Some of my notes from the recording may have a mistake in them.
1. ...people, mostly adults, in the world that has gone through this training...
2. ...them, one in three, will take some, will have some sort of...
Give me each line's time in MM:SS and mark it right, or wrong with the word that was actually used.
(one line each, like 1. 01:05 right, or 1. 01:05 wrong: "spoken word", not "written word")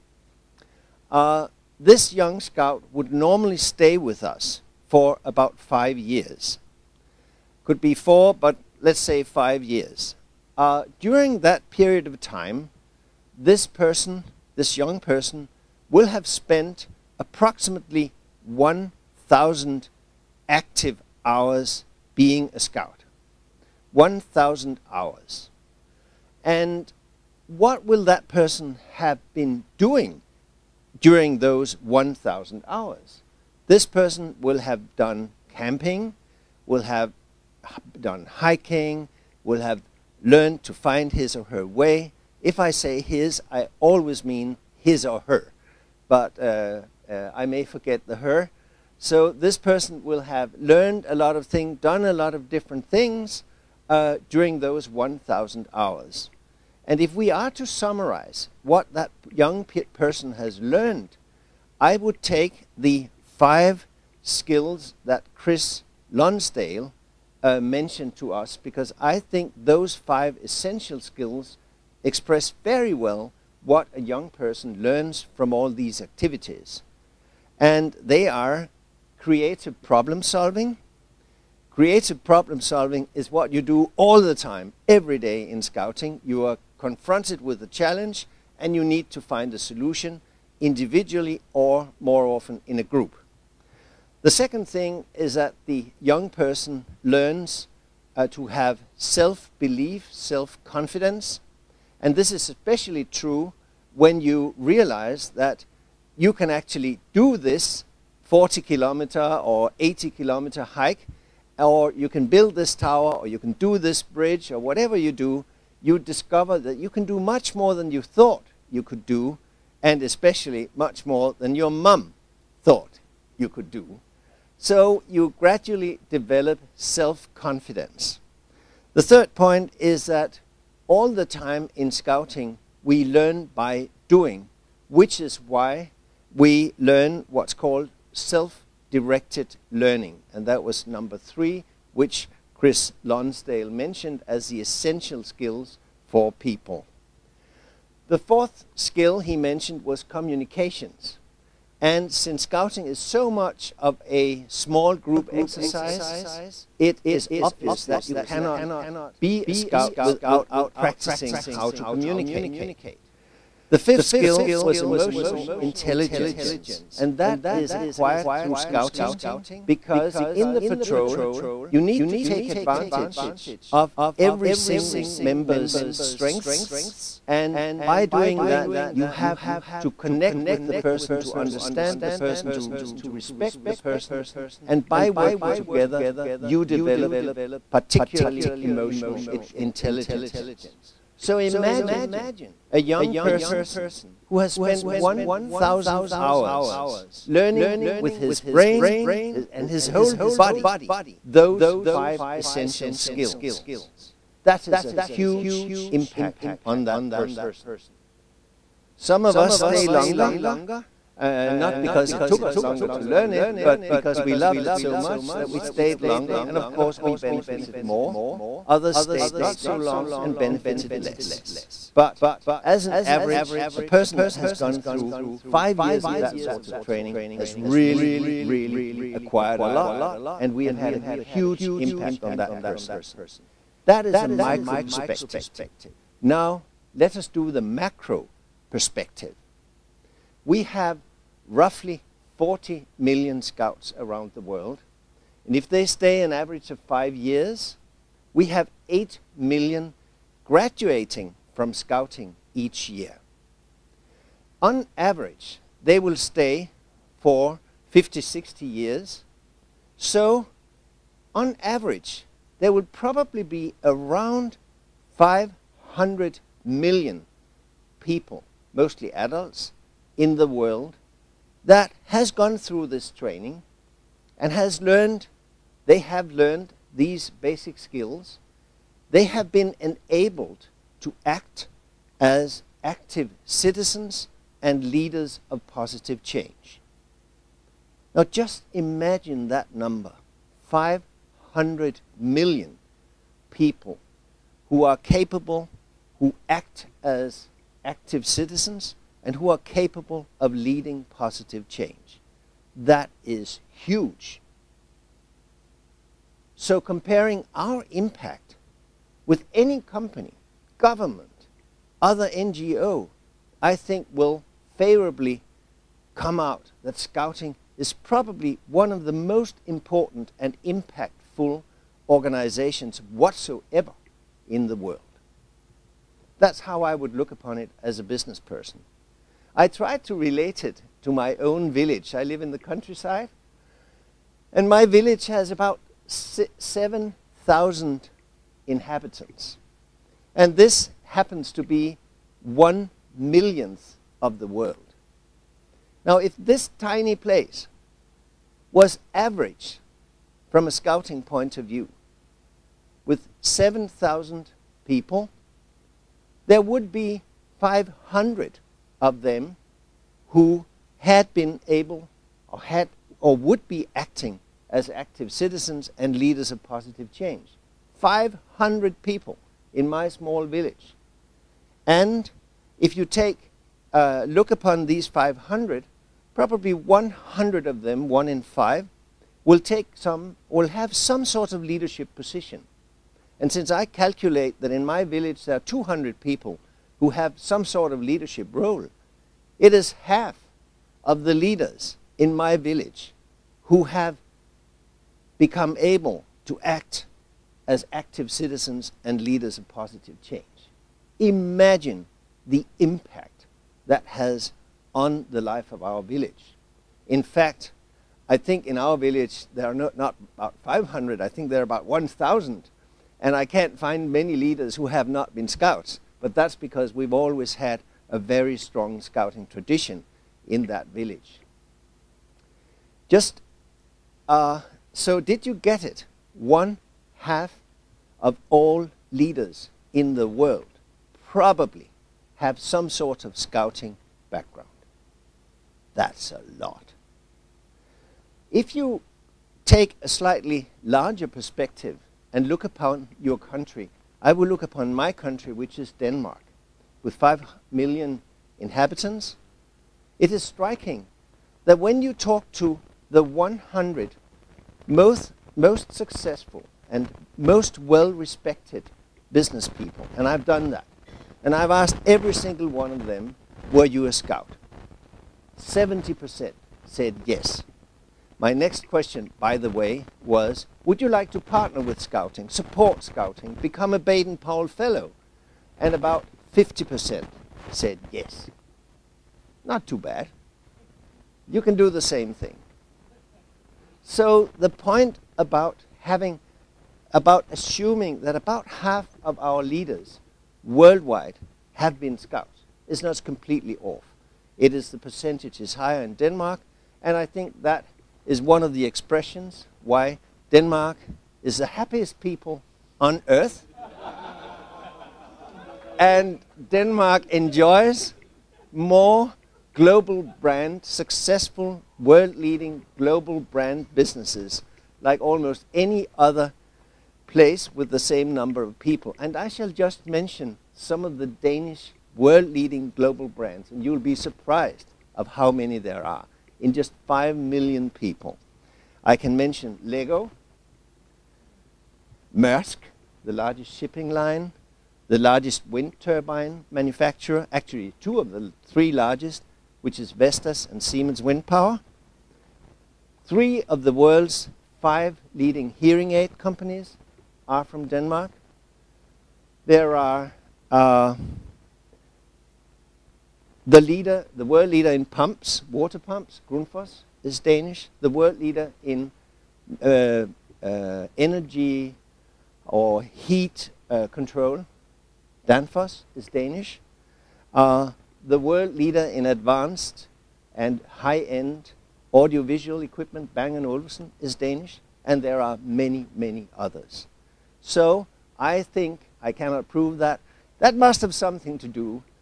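1. 04:28 right
2. 06:17 wrong: "five", not "three".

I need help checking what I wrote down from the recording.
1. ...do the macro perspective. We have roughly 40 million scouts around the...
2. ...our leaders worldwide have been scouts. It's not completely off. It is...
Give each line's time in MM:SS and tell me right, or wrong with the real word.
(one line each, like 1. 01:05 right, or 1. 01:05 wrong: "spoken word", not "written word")
1. 03:57 right
2. 08:09 right.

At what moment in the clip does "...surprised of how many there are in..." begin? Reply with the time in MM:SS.
08:44.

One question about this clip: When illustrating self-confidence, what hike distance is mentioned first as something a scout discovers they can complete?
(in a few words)
40 kilometers.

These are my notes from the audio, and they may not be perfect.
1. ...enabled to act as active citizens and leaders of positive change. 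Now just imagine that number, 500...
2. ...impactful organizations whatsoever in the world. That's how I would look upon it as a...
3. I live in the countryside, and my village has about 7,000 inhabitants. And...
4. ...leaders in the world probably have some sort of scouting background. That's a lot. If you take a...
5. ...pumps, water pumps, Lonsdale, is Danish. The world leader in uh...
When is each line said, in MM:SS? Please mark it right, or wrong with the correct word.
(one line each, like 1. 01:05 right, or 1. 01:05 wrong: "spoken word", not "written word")
1. 04:39 right
2. 05:20 right
3. 05:32 right
4. 07:09 right
5. 09:15 wrong: "Grundfos", not "Lonsdale".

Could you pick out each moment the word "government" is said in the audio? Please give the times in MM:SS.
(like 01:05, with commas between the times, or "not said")
05:10.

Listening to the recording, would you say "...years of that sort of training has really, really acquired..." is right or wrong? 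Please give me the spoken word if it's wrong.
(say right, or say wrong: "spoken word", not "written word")
right.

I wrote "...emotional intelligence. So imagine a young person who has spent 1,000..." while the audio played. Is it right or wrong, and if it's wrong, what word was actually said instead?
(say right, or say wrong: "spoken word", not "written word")
right.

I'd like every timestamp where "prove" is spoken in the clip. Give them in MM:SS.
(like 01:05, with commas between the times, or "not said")
09:39.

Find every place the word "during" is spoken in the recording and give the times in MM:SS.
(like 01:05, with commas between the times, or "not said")
00:11, 00:31, 00:54.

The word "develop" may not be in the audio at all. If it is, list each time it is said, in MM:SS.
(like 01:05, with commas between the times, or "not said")
02:06, 03:06.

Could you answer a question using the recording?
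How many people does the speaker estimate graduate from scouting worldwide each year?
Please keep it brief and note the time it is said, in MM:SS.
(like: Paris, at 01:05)
8 million, at 04:08.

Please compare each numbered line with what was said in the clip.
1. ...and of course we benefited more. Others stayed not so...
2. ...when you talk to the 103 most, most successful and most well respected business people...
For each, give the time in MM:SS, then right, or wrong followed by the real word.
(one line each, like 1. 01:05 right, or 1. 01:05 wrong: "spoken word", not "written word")
1. 03:36 right
2. 07:31 wrong: "100", not "103".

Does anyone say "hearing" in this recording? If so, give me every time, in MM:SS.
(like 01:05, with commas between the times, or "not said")
09:05.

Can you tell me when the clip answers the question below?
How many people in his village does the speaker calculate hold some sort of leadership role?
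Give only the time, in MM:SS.
06:25.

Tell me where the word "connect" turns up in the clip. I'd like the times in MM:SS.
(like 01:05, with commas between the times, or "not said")
02:59.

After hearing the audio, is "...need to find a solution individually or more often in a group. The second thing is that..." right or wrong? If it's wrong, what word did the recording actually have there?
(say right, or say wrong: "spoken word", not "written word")
right.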